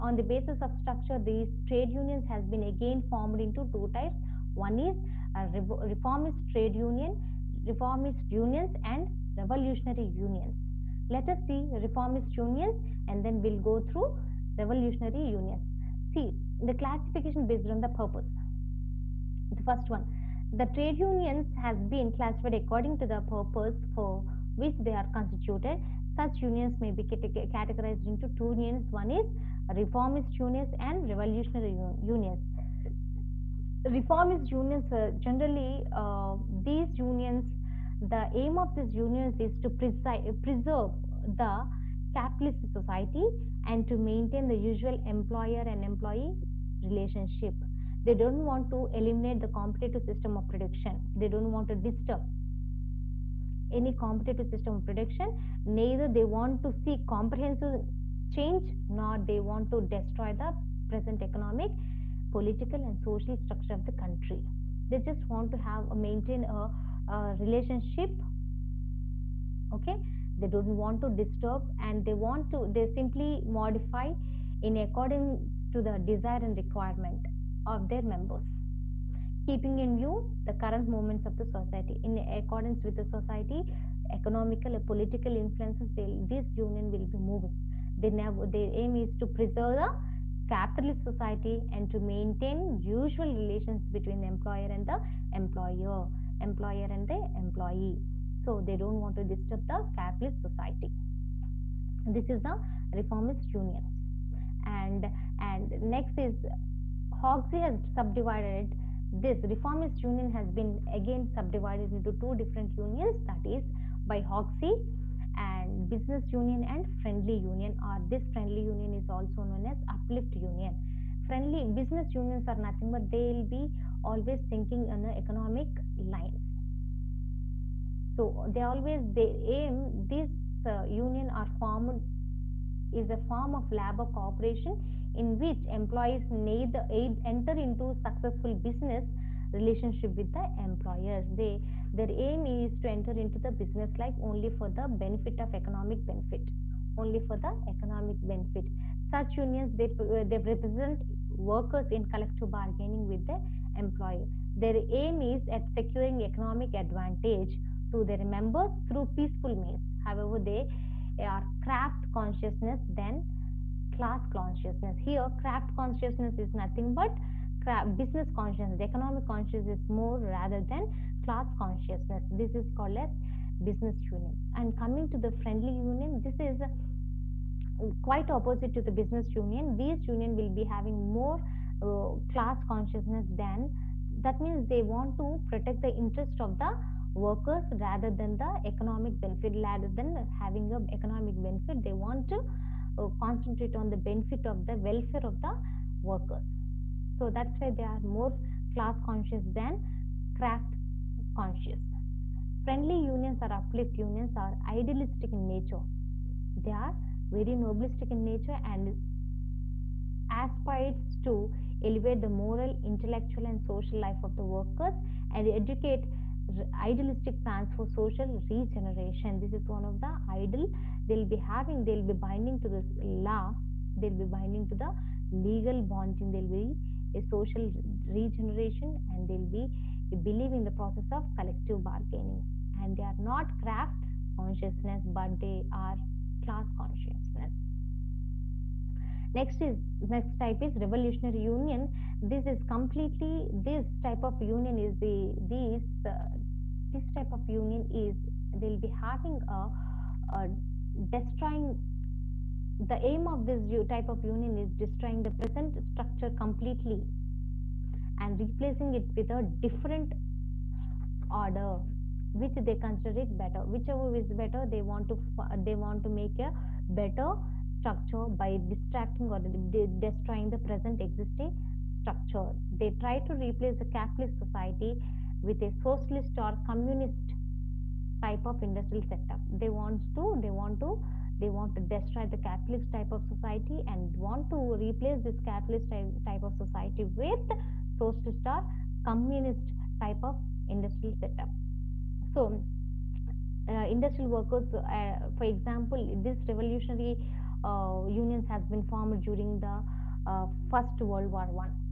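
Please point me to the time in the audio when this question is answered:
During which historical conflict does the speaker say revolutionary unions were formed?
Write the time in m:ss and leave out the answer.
5:00.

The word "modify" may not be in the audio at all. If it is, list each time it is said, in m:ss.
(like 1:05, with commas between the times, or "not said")
1:13.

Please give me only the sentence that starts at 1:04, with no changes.
They just want to have a uh, maintain a, a relationship.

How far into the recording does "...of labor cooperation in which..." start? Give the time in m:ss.
2:13.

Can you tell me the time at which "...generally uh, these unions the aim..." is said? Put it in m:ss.
0:35.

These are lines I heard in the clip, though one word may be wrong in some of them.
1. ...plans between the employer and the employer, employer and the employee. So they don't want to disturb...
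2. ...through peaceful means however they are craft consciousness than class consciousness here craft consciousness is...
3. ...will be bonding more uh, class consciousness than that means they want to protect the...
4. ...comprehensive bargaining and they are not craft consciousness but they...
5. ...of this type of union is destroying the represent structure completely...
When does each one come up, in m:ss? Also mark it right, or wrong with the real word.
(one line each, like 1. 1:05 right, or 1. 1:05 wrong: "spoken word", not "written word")
1. 1:33 wrong: "relations", not "plans"
2. 2:38 right
3. 3:00 wrong: "having", not "bonding"
4. 3:51 wrong: "collective", not "comprehensive"
5. 4:13 wrong: "present", not "represent".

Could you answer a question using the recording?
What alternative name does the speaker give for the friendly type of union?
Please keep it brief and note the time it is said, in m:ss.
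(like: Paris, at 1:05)
Uplift union, at 1:59.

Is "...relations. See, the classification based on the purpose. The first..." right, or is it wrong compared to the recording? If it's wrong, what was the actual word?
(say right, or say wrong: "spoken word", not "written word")
wrong: "unions", not "relations".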